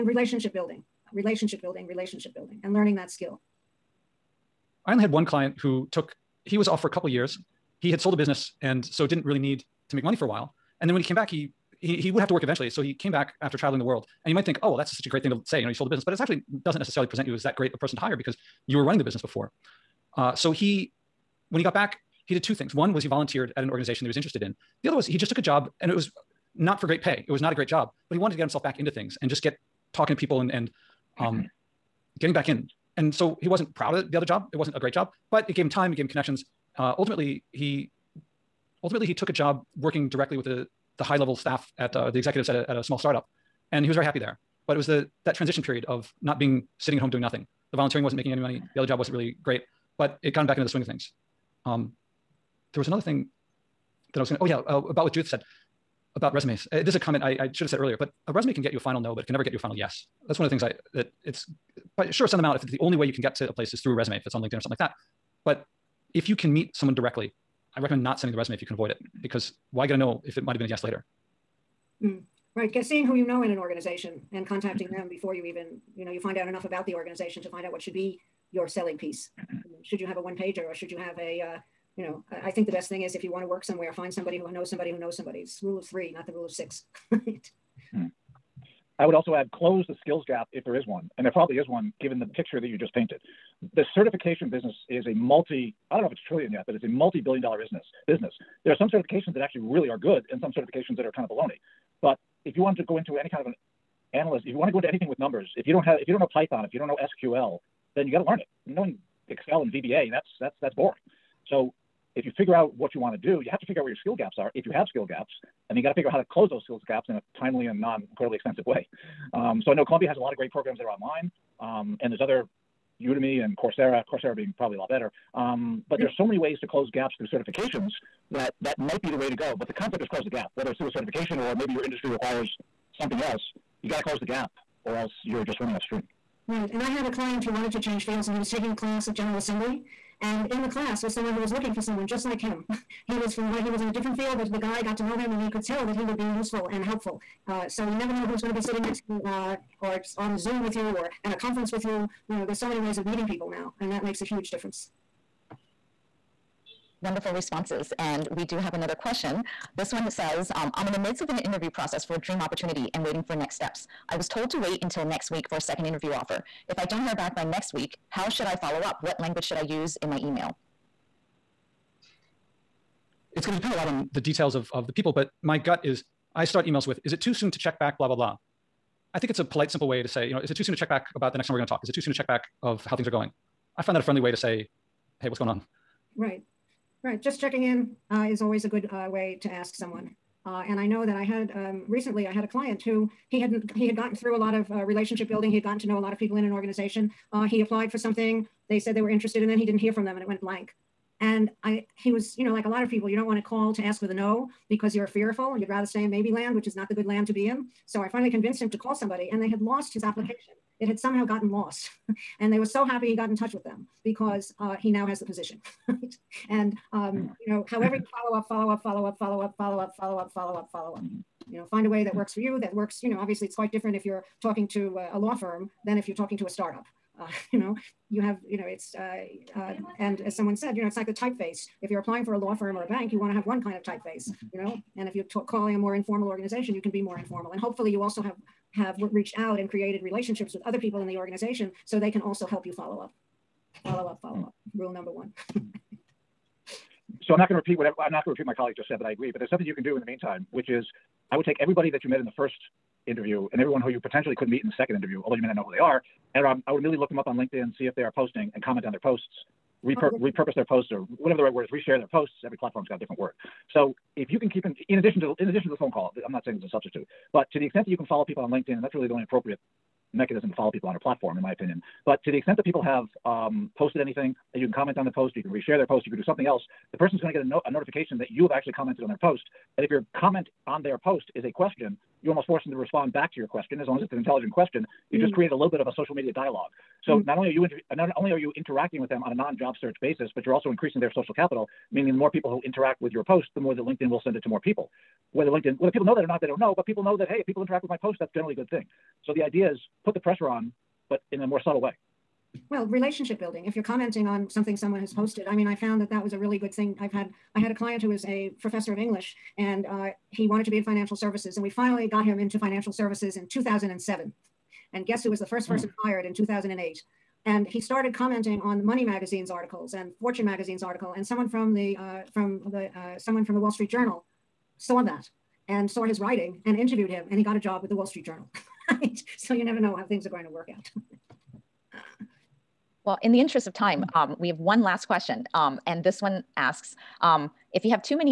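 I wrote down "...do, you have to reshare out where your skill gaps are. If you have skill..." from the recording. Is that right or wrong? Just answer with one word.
wrong.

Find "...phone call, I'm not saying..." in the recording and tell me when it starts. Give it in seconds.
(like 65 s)
265 s.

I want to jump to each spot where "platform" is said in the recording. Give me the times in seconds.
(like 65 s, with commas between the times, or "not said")
262 s, 270 s.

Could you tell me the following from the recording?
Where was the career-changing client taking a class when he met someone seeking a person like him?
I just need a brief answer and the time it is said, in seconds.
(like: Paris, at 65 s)
General Assembly, at 139 s.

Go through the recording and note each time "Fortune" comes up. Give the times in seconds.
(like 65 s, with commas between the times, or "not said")
320 s.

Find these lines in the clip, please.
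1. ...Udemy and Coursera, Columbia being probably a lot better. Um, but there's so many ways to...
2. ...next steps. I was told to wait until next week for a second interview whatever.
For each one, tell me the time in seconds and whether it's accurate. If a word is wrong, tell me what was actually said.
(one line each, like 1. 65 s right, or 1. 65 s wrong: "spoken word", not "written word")
1. 123 s wrong: "Coursera", not "Columbia"
2. 163 s wrong: "offer", not "whatever".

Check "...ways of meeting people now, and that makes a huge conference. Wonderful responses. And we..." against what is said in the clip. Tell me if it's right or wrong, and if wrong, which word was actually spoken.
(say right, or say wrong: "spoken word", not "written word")
wrong: "difference", not "conference".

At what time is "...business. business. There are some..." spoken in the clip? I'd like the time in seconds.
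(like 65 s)
97 s.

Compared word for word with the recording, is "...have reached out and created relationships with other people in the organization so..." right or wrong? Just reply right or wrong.
right.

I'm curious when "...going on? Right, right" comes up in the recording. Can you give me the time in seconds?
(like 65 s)
185 s.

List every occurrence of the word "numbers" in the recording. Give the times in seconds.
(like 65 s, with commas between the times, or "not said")
105 s, 244 s.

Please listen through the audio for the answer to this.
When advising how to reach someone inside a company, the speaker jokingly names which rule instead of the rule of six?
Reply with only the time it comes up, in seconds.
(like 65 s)
85 s.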